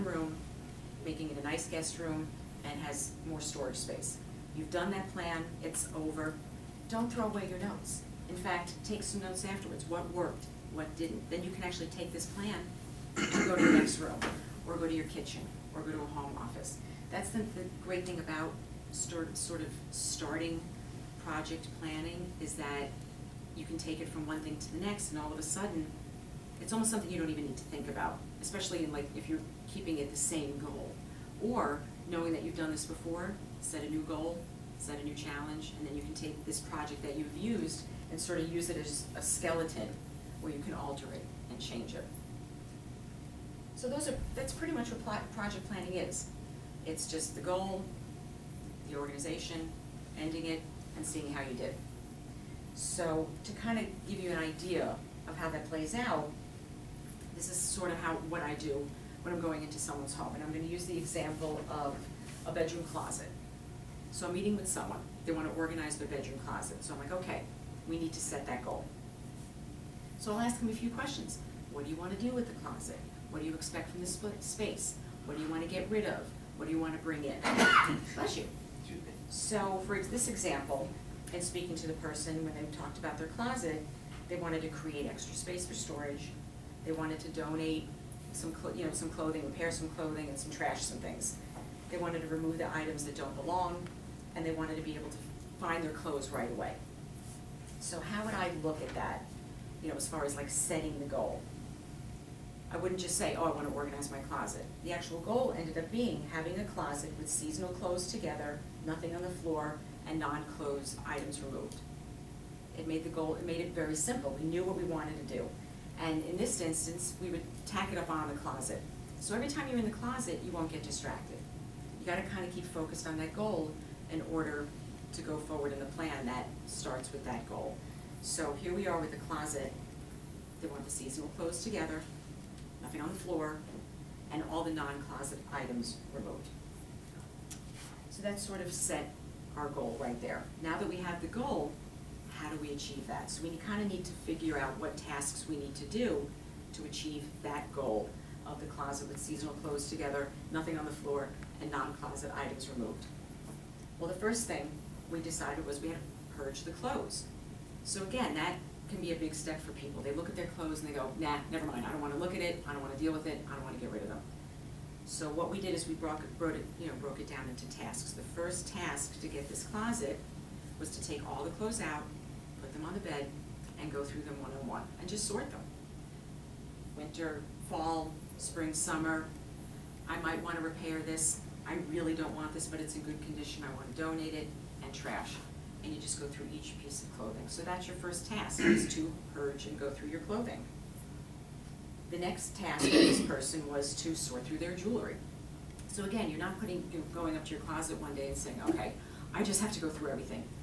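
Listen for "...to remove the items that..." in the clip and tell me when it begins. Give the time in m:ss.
1:32.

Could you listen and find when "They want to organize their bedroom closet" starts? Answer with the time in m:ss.
1:05.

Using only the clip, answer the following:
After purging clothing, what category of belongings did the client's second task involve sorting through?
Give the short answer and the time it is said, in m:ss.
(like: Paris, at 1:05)
jewelry, at 3:14.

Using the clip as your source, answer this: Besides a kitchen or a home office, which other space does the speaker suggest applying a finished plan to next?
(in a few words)
the next room.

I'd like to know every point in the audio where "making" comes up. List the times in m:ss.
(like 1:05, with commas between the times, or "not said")
0:01.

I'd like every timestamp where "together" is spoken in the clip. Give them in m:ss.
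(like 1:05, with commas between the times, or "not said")
1:48, 2:11, 2:29.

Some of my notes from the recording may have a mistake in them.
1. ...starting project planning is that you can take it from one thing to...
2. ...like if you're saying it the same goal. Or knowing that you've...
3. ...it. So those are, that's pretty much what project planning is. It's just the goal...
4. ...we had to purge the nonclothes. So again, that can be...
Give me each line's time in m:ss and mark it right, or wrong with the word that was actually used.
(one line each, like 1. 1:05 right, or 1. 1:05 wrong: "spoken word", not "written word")
1. 0:19 right
2. 0:28 wrong: "keeping", not "saying"
3. 0:41 right
4. 2:35 wrong: "clothes", not "nonclothes".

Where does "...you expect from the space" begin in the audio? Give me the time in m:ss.
1:13.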